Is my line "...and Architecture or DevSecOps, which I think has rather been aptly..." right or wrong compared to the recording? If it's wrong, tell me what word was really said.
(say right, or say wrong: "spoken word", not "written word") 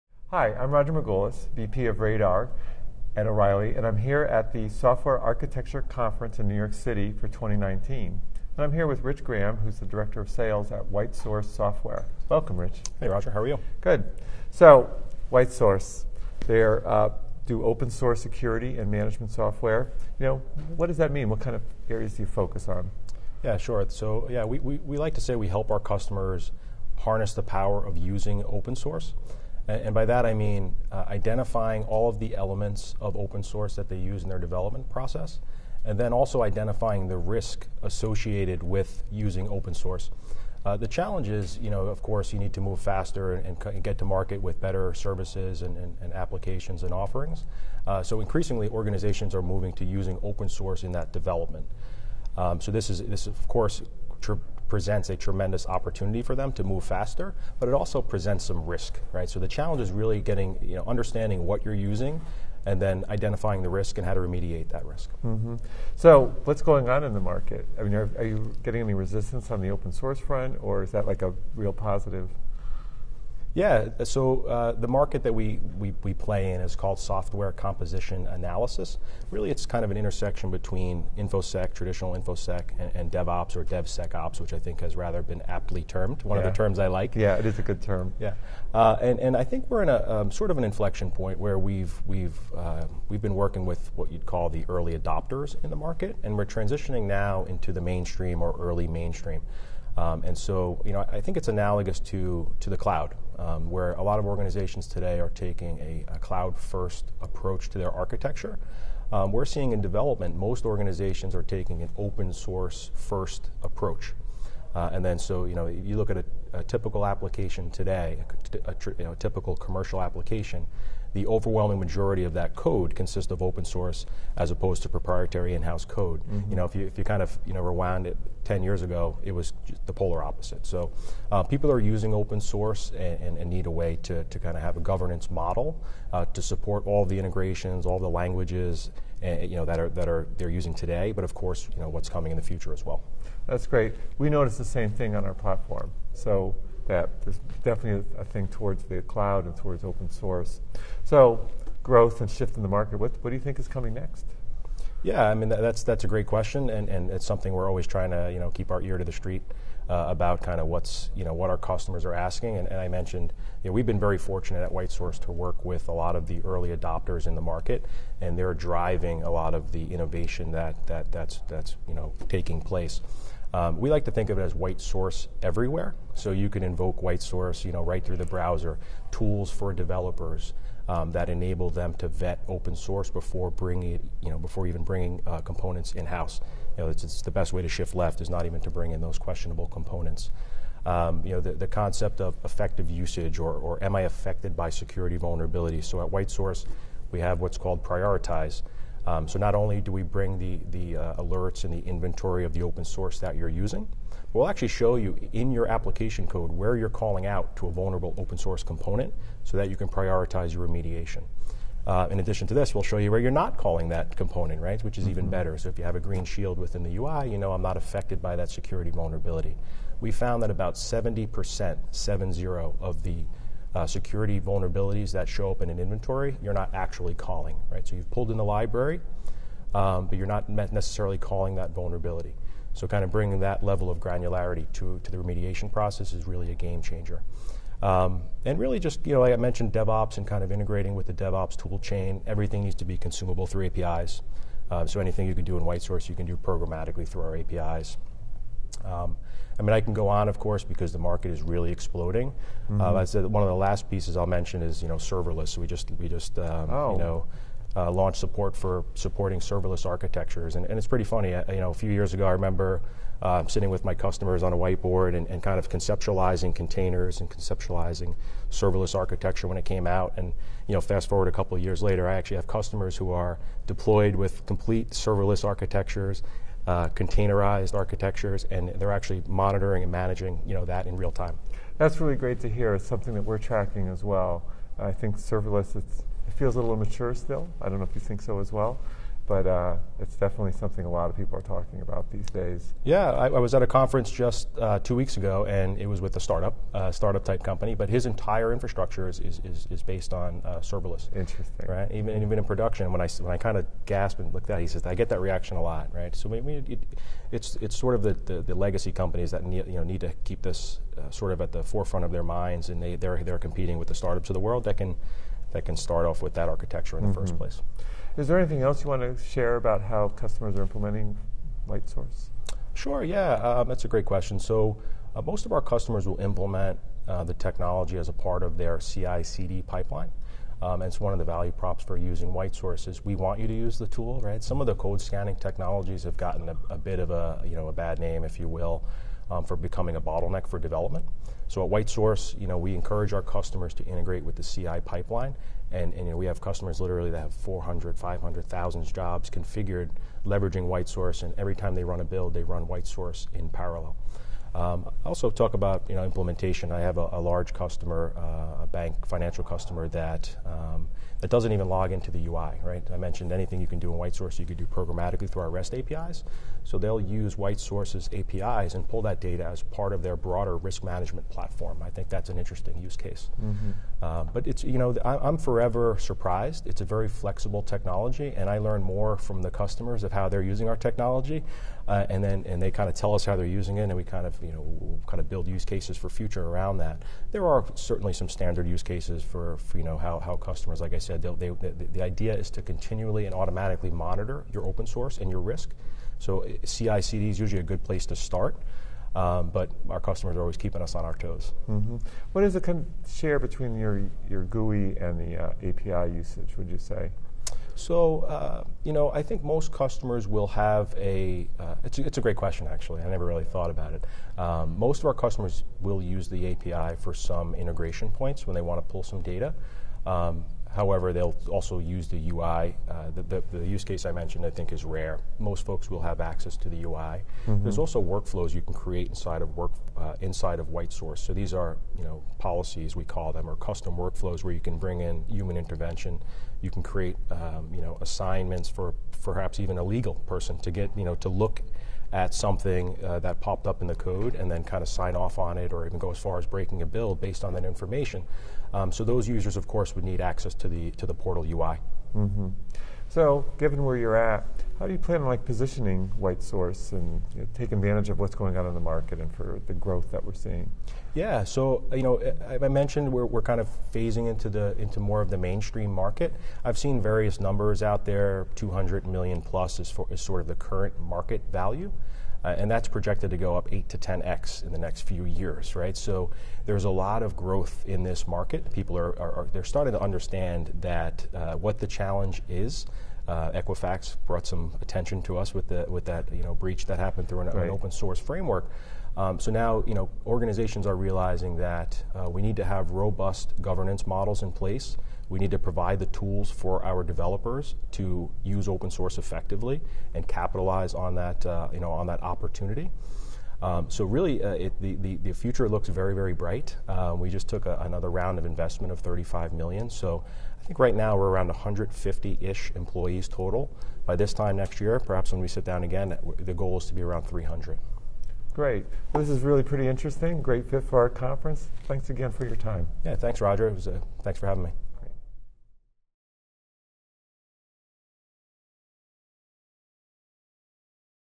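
wrong: "DevOps", not "Architecture".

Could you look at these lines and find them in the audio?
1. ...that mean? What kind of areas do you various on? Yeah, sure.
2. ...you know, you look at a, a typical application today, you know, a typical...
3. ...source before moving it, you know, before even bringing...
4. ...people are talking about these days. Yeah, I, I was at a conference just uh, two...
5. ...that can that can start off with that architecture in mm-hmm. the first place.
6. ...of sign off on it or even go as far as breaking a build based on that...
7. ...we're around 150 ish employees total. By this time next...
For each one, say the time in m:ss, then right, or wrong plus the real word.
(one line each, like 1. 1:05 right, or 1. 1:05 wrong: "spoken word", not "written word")
1. 0:20 wrong: "focus", not "various"
2. 1:55 right
3. 3:02 wrong: "bringing", not "moving"
4. 4:51 right
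5. 5:14 right
6. 7:24 right
7. 8:31 right.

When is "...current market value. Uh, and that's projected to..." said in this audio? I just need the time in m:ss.
7:50.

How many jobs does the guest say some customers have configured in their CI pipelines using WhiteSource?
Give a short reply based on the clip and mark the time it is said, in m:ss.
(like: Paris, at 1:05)
400,000 to 500,000, at 5:47.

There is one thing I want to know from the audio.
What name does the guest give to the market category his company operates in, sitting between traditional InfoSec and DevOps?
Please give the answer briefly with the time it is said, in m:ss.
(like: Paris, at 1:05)
Software composition analysis, at 1:16.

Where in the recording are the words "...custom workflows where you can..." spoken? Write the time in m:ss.
7:13.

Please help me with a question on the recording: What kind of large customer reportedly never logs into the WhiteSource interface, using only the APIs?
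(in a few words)
A bank financial customer.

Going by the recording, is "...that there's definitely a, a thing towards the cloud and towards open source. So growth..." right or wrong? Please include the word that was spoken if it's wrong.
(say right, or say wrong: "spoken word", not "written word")
right.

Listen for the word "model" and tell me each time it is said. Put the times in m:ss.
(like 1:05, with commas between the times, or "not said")
2:15, 8:14.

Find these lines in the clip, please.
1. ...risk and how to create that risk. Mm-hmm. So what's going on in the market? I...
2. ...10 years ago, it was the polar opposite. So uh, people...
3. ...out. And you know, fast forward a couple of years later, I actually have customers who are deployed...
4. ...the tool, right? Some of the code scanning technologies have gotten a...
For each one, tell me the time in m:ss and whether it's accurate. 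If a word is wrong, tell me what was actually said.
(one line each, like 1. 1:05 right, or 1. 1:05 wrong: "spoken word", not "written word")
1. 1:03 wrong: "remediate", not "create"
2. 2:08 right
3. 4:29 right
4. 5:33 right.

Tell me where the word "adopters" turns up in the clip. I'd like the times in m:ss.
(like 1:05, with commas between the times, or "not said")
1:34, 2:46.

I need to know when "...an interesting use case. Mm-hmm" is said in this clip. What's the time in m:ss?
6:12.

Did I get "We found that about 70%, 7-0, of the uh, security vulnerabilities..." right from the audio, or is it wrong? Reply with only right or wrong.
right.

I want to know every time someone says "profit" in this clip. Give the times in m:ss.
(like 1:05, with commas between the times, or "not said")
not said.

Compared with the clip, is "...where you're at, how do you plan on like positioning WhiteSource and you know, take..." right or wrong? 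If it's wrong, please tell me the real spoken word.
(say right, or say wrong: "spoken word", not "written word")
right.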